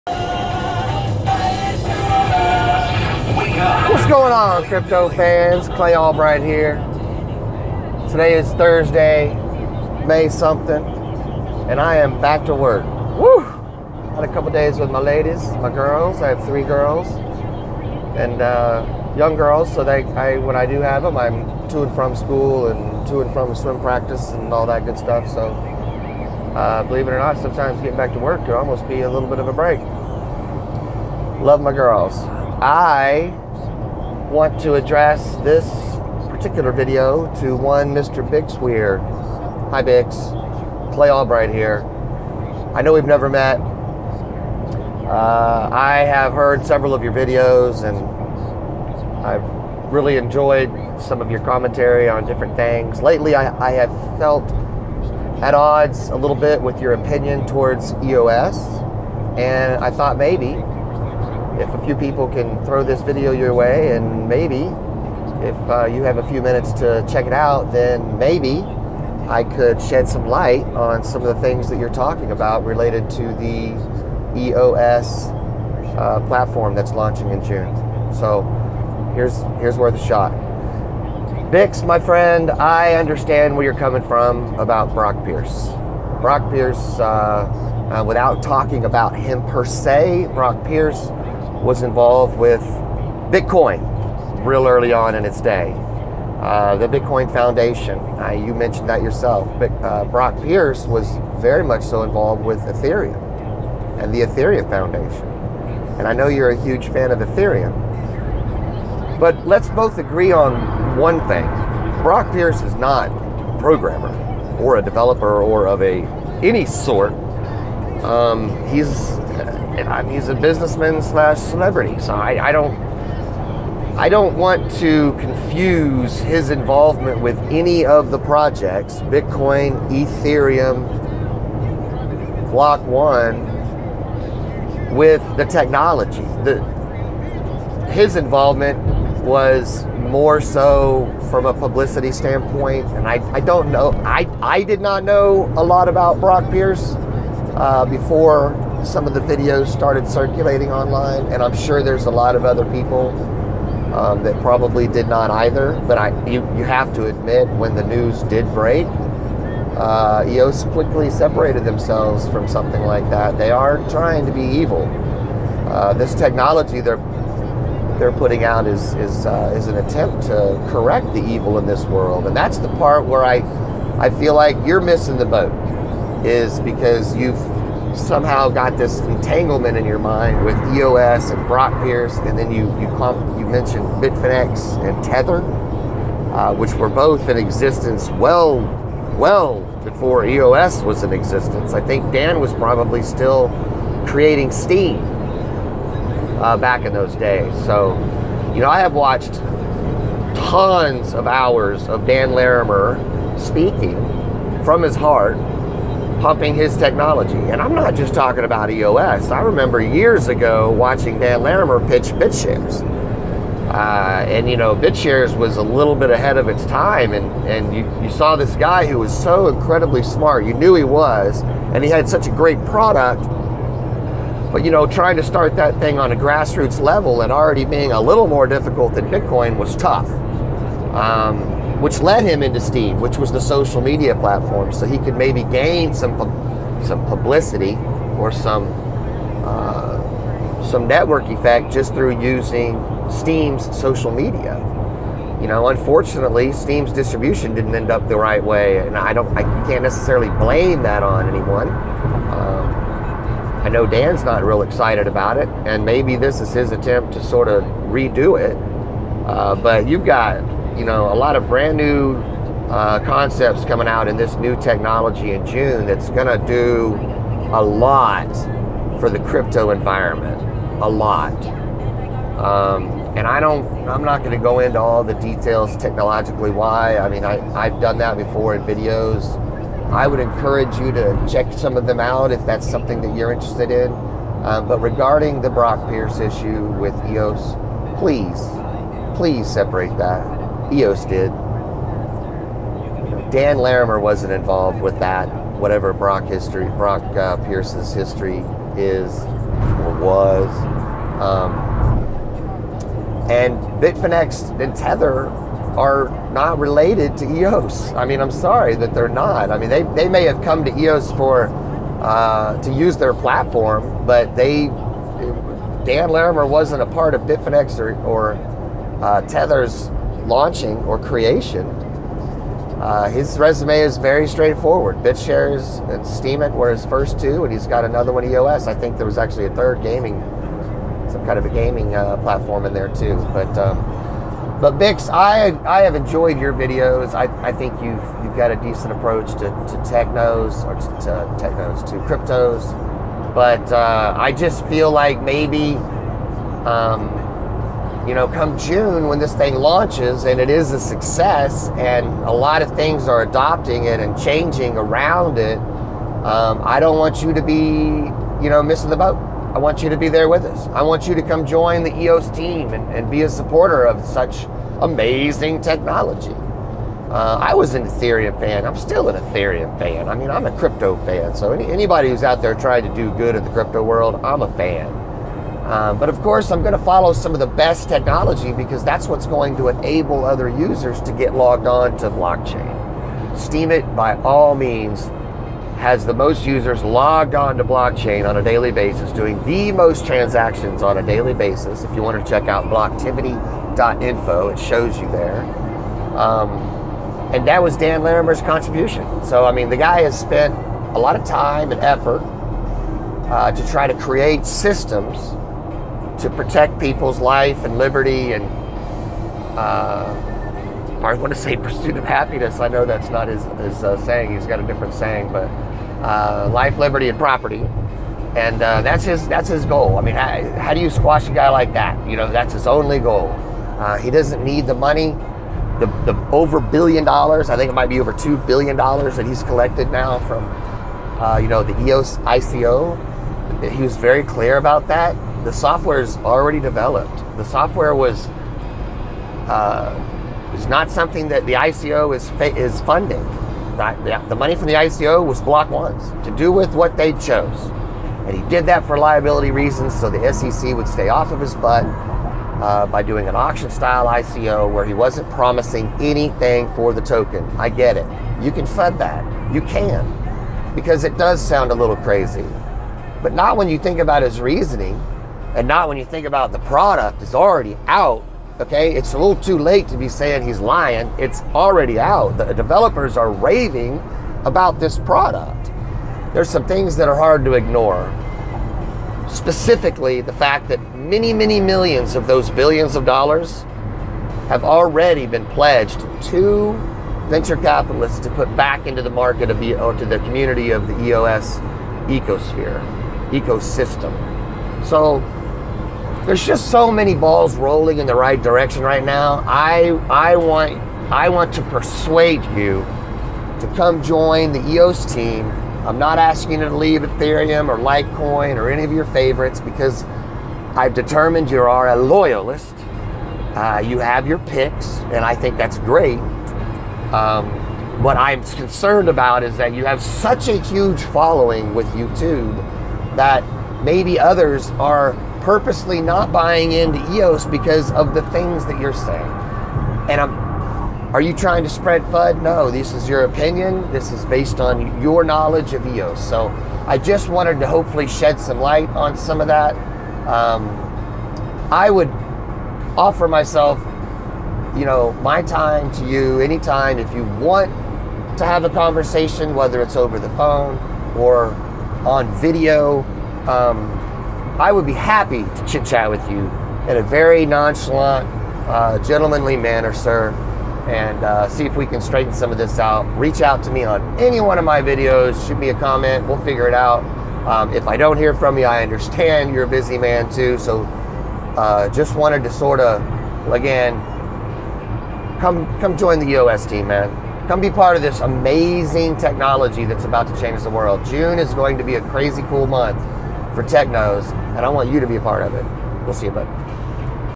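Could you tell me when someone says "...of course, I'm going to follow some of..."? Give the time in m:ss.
6:16.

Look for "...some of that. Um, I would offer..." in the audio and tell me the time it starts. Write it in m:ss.
8:59.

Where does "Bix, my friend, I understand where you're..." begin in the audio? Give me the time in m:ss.
1:21.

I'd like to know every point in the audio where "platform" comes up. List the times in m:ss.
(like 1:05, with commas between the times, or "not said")
1:16, 3:54, 5:13, 5:32.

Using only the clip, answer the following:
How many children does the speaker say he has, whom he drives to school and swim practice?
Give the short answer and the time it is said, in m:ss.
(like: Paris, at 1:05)
3, at 0:16.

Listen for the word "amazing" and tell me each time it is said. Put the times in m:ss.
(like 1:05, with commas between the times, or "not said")
6:04, 9:38.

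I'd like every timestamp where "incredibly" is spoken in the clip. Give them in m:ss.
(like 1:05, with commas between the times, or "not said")
3:39.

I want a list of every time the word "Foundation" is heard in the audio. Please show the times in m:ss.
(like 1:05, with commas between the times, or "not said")
1:37, 1:44.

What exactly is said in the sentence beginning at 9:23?
Reach out to me on any one of my videos, shoot me a comment, we'll figure it out.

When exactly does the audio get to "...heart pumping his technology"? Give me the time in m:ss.
3:24.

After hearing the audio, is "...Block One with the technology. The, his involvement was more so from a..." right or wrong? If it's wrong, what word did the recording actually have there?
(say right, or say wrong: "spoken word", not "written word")
right.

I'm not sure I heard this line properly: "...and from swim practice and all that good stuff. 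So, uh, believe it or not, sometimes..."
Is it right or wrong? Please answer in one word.
right.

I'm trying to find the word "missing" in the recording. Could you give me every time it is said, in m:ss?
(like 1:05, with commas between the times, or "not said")
2:54, 5:58.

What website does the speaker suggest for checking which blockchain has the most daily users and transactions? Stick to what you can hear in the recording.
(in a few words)
blocktivity.info.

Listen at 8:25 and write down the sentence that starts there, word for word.
I'm not asking you to leave Ethereum or Litecoin or any of your favorites because I've determined you are a loyalist.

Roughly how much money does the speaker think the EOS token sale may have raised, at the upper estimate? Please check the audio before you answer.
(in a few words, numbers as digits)
over $2 billion.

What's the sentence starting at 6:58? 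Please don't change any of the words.
And uh, that's his that's his goal.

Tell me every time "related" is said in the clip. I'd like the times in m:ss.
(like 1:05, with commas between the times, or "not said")
1:12, 5:06.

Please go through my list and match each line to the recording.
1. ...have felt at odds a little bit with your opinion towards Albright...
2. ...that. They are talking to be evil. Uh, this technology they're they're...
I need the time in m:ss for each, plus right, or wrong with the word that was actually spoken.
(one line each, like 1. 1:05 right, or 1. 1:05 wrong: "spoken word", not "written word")
1. 0:53 wrong: "EOS", not "Albright"
2. 2:43 wrong: "trying", not "talking".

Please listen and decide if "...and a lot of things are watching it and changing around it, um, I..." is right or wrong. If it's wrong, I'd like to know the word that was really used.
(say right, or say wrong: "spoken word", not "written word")
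wrong: "adopting", not "watching".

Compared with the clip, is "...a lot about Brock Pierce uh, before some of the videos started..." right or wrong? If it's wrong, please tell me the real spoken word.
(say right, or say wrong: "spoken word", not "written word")
right.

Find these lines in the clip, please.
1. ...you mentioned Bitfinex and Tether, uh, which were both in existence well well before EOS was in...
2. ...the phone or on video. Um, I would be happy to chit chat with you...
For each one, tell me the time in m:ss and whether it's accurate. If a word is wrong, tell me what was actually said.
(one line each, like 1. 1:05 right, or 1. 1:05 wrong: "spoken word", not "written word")
1. 3:03 right
2. 9:10 right.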